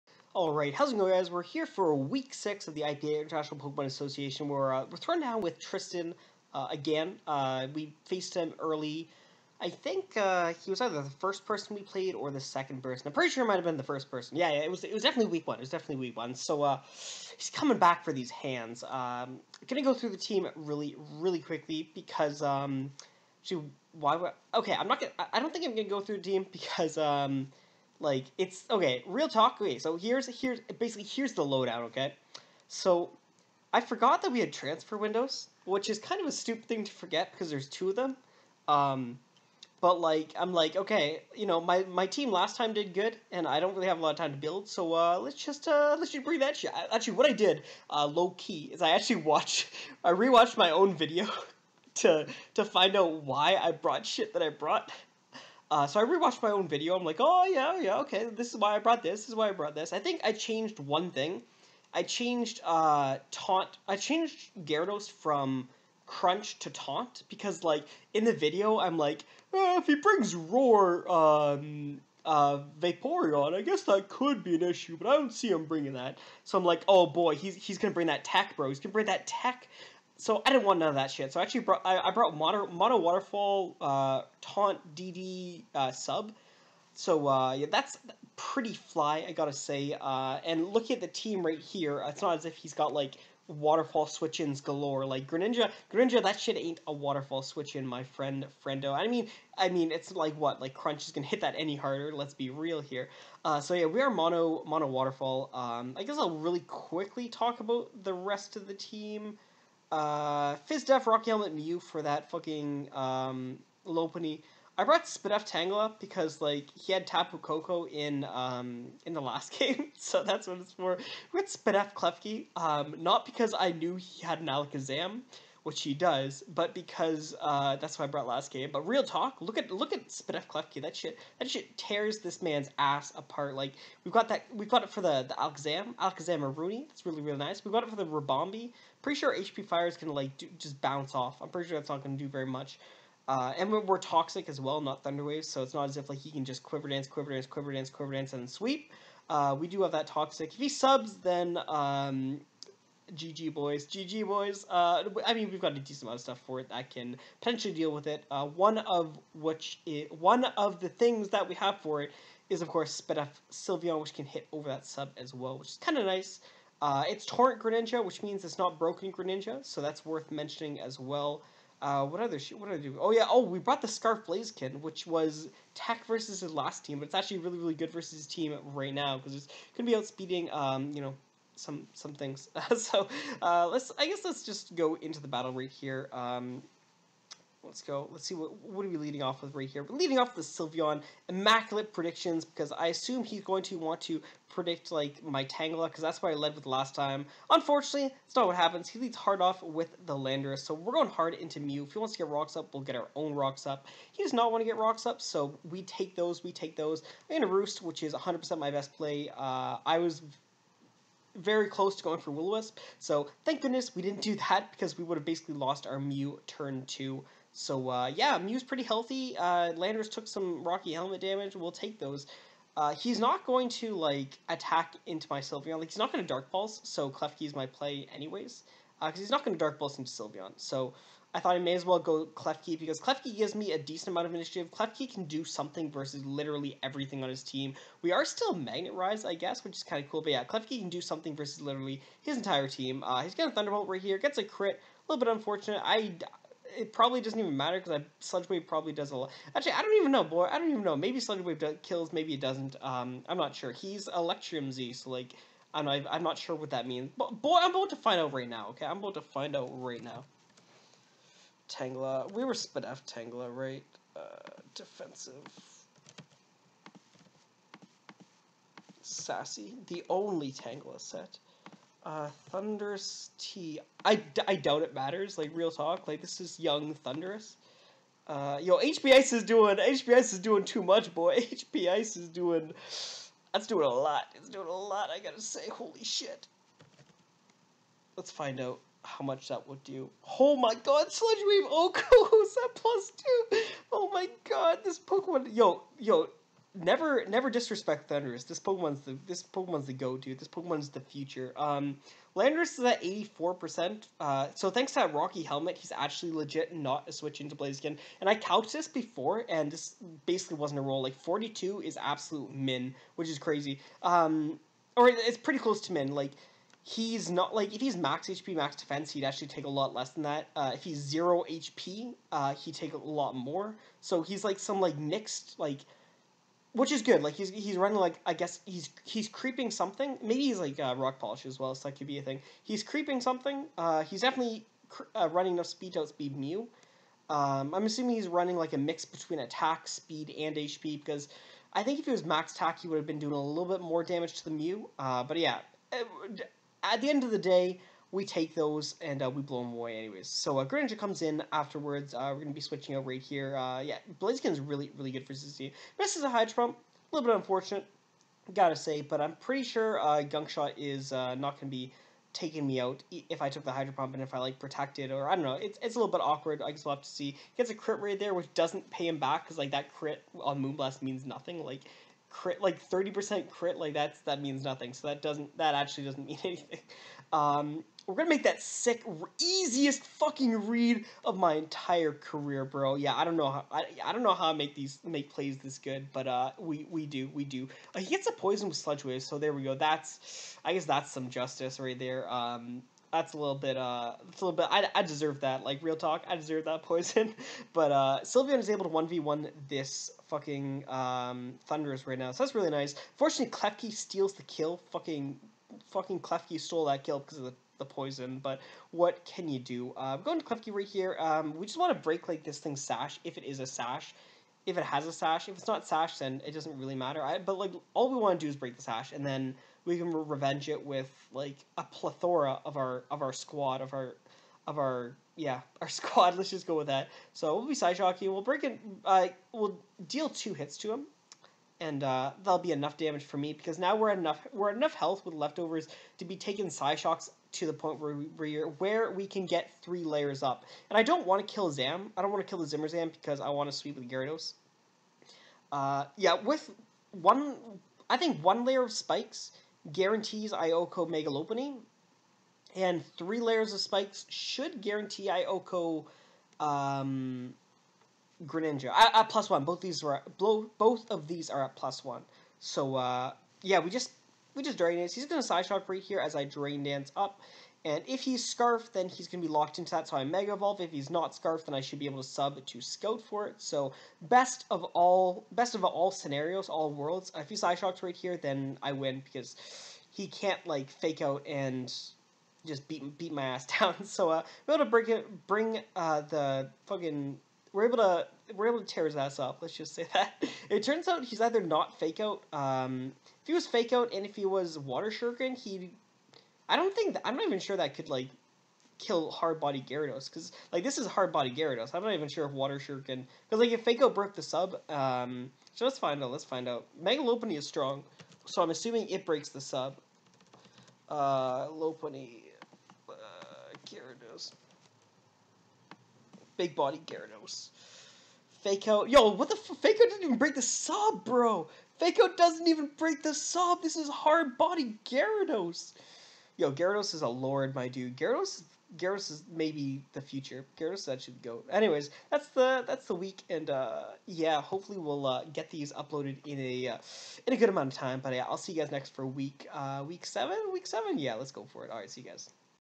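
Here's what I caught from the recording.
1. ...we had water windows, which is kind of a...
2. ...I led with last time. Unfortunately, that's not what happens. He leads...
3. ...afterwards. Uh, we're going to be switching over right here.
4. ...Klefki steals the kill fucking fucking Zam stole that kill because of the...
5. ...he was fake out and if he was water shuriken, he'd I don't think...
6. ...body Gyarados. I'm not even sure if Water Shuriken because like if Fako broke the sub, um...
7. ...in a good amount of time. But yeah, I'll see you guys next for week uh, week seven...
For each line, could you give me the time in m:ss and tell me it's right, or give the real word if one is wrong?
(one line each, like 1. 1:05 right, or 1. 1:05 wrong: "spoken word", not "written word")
1. 0:34 wrong: "transfer", not "water"
2. 3:16 right
3. 5:51 right
4. 6:43 wrong: "Klefki", not "Zam"
5. 8:13 right
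6. 8:21 right
7. 8:57 right.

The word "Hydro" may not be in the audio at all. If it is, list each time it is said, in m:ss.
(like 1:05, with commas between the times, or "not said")
5:56, 6:03.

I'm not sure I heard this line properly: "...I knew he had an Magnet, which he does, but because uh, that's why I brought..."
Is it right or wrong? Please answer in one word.
wrong.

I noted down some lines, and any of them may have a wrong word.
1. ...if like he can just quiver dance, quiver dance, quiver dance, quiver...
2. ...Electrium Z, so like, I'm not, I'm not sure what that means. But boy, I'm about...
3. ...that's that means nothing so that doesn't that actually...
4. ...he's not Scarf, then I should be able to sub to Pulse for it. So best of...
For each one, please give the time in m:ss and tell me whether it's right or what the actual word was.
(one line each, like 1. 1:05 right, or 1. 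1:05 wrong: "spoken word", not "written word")
1. 2:25 right
2. 4:14 right
3. 6:13 right
4. 7:50 wrong: "Scout", not "Pulse".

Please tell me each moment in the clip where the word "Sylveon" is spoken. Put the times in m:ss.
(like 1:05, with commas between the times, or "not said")
2:43, 3:10, 3:45, 3:50, 6:38.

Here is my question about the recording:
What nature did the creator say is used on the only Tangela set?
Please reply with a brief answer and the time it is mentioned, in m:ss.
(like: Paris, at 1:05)
Sassy, at 4:29.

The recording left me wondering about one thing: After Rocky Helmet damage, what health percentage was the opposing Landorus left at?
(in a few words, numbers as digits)
84%.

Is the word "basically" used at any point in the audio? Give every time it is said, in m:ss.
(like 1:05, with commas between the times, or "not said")
0:30, 3:35, 5:10.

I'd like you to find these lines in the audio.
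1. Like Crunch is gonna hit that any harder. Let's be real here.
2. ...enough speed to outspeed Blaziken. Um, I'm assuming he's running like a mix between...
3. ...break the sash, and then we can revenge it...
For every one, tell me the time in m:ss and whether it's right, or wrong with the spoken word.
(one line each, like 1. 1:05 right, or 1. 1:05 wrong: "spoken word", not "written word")
1. 1:40 right
2. 5:35 wrong: "Mew", not "Blaziken"
3. 6:58 right.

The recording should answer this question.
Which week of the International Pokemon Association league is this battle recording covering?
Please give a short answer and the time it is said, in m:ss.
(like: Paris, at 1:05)
Week 6, at 0:01.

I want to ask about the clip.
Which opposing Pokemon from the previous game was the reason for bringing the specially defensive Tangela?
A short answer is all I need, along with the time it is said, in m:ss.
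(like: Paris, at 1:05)
Tapu Koko, at 1:57.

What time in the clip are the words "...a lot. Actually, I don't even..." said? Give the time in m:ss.
4:09.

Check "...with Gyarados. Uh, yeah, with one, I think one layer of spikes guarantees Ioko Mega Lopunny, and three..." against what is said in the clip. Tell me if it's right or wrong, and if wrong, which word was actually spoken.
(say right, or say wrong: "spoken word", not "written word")
right.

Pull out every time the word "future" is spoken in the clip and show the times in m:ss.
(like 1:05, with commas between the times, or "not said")
5:00, 8:50.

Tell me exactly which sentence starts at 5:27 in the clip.
Like he's he's running like I guess he's he's creeping something.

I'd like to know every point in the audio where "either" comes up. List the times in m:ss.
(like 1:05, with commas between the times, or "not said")
0:10, 8:11.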